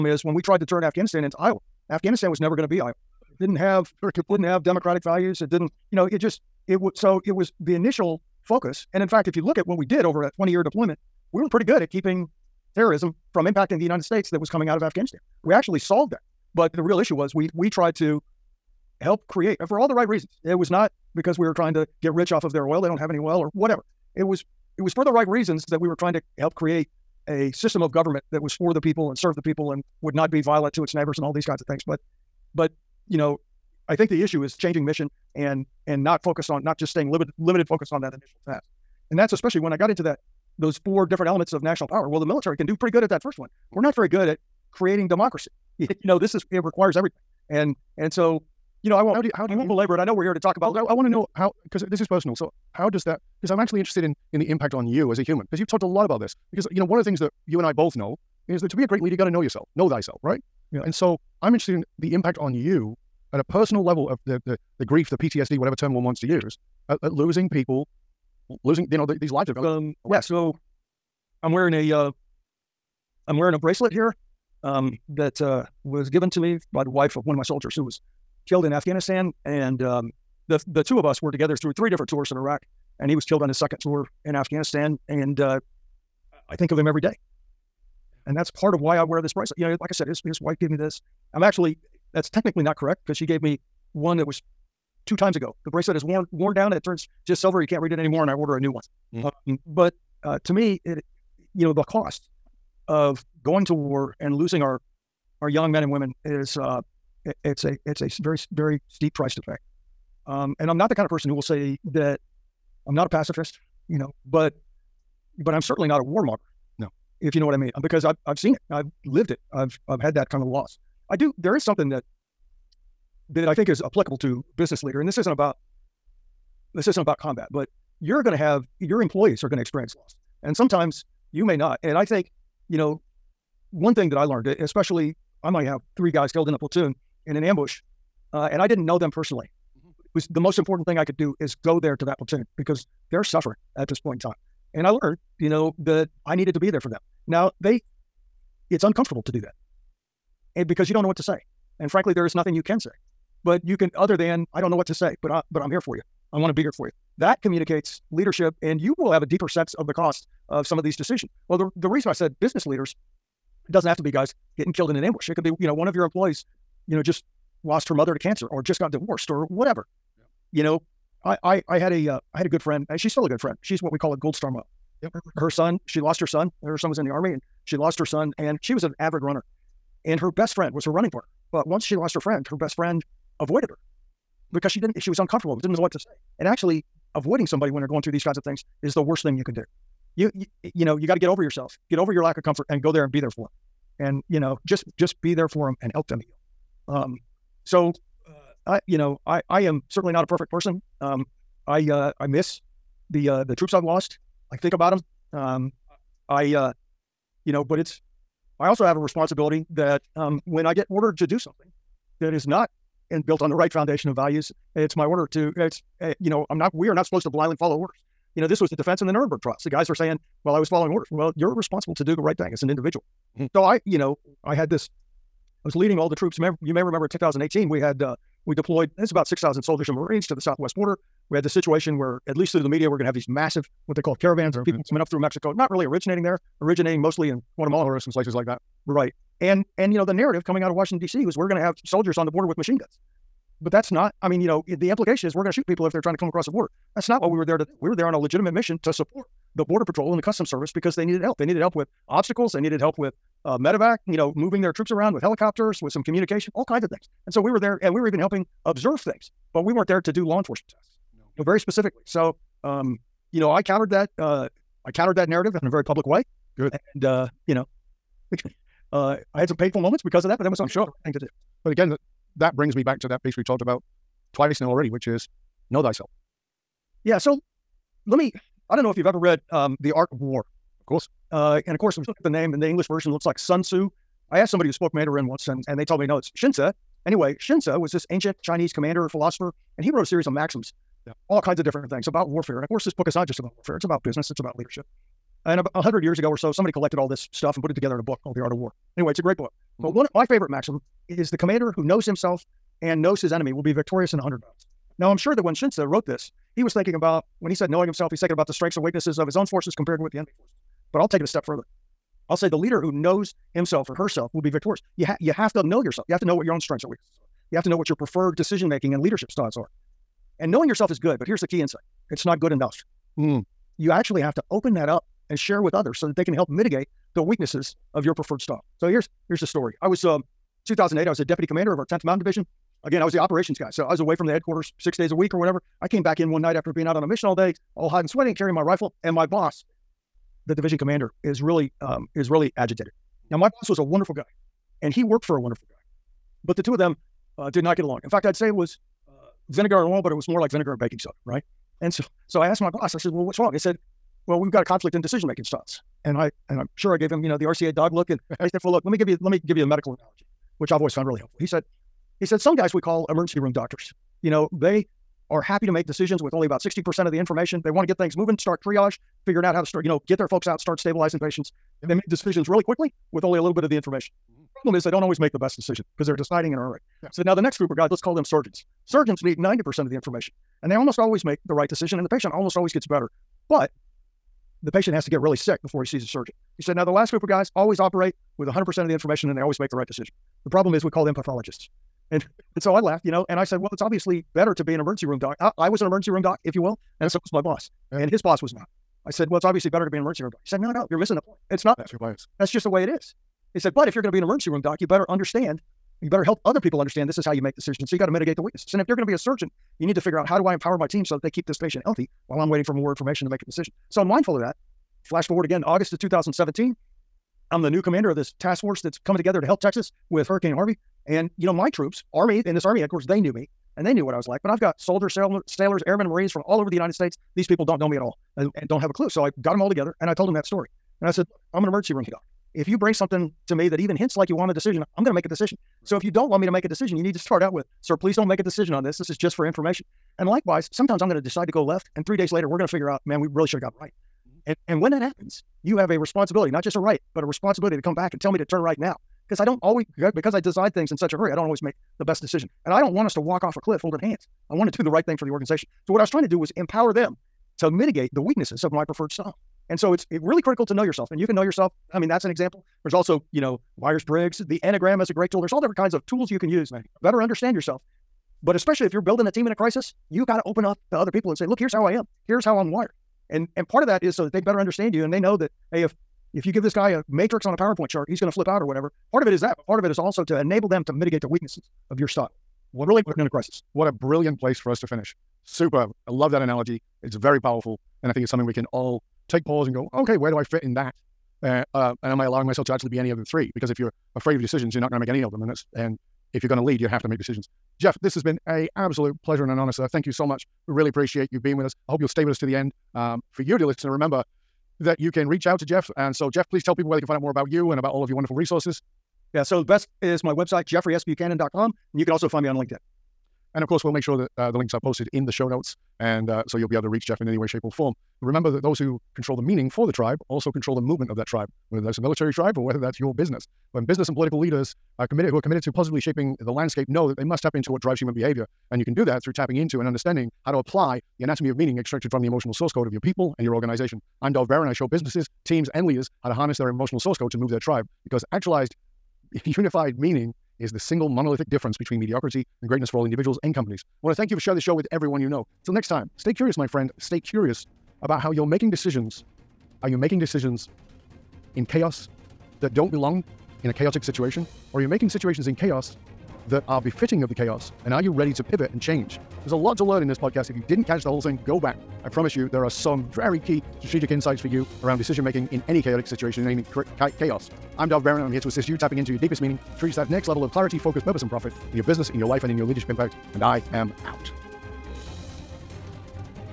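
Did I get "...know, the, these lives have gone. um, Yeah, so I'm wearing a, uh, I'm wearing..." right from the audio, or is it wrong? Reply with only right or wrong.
right.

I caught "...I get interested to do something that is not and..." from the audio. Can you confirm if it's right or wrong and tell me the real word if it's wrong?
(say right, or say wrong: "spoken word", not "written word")
wrong: "ordered", not "interested".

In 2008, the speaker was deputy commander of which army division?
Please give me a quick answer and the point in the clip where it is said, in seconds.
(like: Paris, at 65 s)
10th Mountain Division, at 331 s.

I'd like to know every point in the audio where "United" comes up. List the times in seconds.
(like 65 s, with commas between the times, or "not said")
13 s, 426 s.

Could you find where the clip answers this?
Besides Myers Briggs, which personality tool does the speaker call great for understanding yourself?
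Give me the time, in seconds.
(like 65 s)
464 s.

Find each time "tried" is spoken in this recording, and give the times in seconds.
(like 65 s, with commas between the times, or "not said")
0 s, 17 s.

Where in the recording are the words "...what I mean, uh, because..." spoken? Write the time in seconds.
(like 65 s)
117 s.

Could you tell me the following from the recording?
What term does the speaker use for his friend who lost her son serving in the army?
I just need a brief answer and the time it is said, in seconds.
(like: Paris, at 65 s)
gold star mom, at 174 s.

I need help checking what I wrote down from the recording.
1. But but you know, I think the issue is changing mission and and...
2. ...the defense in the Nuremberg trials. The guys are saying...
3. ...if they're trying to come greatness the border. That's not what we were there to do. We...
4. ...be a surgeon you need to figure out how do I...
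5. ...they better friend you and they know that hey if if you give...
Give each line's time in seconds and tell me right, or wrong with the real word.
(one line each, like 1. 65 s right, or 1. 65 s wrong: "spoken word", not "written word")
1. 31 s right
2. 218 s right
3. 245 s wrong: "across", not "greatness"
4. 409 s right
5. 474 s wrong: "understand", not "friend".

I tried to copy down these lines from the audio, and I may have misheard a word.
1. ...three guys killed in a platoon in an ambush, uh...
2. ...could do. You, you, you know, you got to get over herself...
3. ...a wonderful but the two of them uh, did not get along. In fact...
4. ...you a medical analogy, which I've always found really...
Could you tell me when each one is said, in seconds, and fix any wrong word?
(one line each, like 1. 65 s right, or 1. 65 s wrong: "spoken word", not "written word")
1. 135 s right
2. 189 s wrong: "yourself", not "herself"
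3. 345 s right
4. 359 s right.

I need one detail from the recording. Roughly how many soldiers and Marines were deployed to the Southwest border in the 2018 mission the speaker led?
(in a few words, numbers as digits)
6,000.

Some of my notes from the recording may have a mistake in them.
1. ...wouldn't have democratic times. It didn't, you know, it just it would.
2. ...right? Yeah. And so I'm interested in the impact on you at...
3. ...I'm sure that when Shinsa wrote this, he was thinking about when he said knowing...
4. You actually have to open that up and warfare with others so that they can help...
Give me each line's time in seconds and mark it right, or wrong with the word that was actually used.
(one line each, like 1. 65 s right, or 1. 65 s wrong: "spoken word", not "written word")
1. 4 s wrong: "values", not "times"
2. 60 s right
3. 305 s right
4. 323 s wrong: "share", not "warfare".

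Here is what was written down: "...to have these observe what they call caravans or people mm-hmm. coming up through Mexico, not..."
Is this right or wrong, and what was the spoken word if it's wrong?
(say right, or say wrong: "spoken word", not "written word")
wrong: "massive", not "observe".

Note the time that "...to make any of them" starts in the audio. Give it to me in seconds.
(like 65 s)
494 s.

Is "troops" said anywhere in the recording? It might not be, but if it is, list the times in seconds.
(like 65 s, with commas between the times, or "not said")
203 s, 226 s, 254 s, 421 s.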